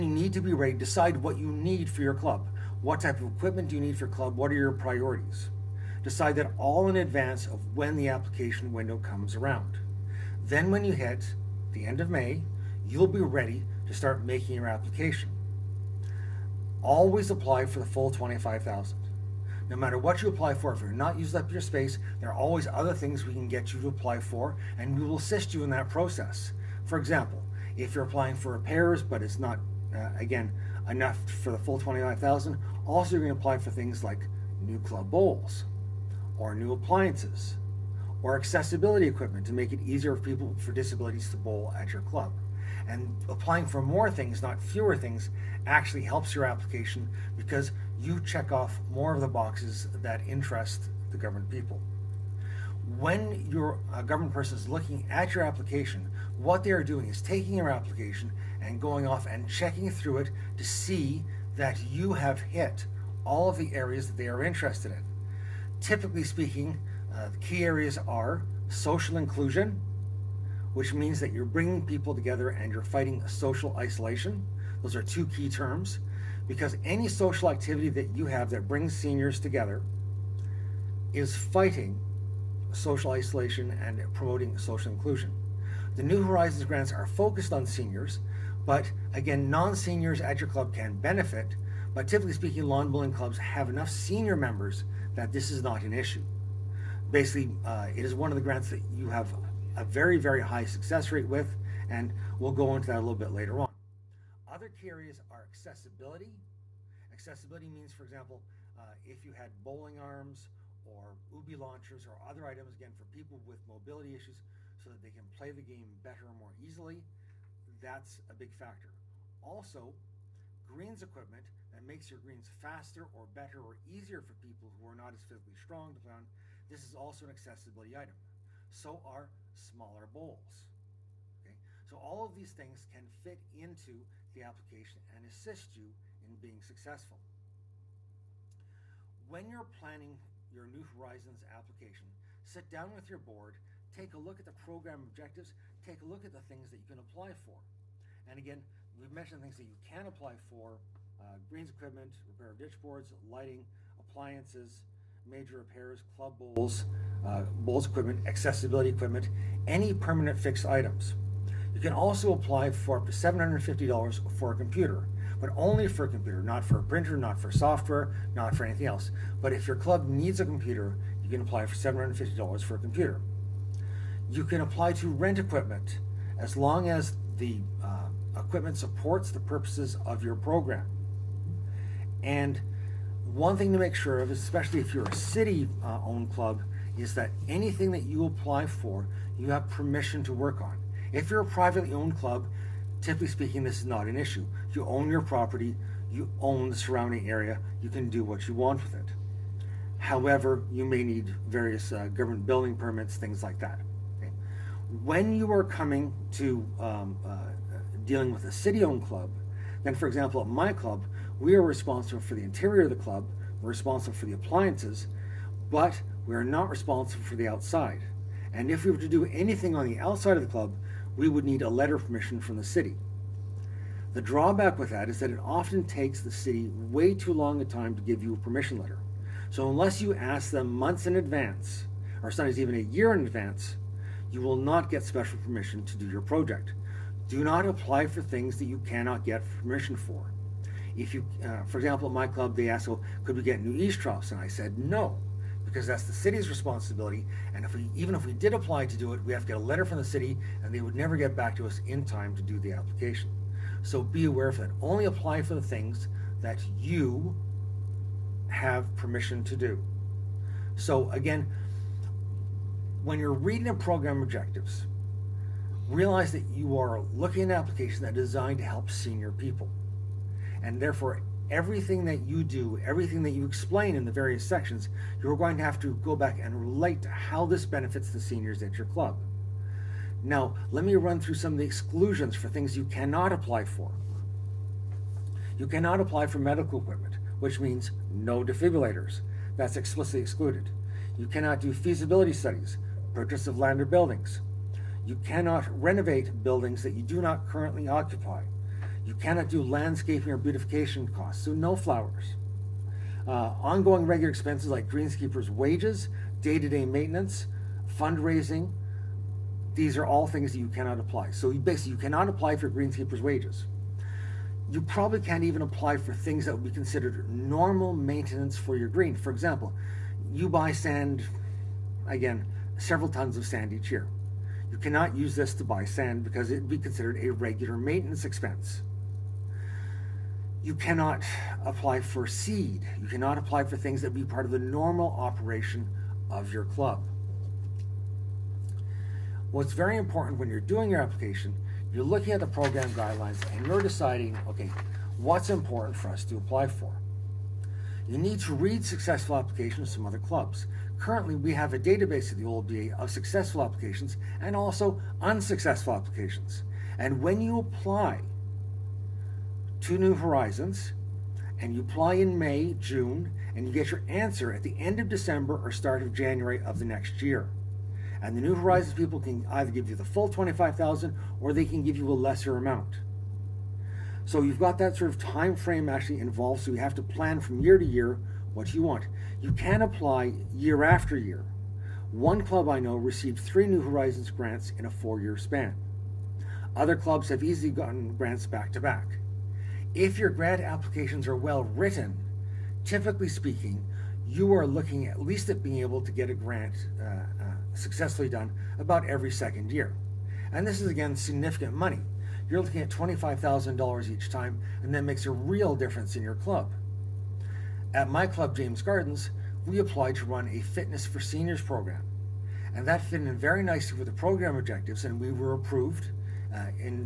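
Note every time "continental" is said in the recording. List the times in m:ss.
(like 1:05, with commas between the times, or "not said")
not said.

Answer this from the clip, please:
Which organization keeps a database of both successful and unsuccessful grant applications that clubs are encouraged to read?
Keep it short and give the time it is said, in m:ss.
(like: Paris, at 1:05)
OLBA, at 5:52.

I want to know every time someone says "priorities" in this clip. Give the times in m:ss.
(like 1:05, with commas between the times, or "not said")
0:04.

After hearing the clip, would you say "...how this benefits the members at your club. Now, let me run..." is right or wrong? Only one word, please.
wrong.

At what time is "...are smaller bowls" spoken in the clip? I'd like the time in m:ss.
2:08.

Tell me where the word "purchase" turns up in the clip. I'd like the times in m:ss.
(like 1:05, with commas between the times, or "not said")
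4:53.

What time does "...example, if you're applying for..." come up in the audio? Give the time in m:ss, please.
0:26.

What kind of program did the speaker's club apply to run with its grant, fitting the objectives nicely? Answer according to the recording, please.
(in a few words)
Fitness for Seniors.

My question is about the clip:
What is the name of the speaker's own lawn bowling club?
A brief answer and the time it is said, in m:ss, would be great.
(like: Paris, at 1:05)
James Gardens, at 6:48.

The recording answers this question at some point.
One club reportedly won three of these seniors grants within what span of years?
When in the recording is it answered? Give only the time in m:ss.
6:24.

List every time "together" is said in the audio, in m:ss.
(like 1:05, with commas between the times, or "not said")
1:12, 1:19.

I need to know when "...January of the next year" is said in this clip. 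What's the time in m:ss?
6:06.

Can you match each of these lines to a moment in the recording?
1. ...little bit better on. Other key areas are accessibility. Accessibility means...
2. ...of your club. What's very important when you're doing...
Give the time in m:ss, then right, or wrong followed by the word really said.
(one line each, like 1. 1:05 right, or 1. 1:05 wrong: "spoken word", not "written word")
1. 1:42 wrong: "later", not "better"
2. 5:36 right.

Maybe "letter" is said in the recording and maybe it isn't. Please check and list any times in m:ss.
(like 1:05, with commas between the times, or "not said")
3:41, 3:48, 4:09.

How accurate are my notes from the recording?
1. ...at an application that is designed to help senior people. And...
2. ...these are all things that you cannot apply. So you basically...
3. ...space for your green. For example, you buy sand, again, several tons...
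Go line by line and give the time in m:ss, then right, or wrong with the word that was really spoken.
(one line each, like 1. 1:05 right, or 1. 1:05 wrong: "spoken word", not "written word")
1. 4:27 right
2. 5:09 right
3. 5:17 wrong: "maintenance", not "space".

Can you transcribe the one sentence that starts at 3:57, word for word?
Do not apply for things that you cannot get permission for.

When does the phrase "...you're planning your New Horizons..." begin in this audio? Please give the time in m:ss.
2:19.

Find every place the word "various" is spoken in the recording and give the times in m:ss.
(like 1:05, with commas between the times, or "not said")
3:21, 4:34.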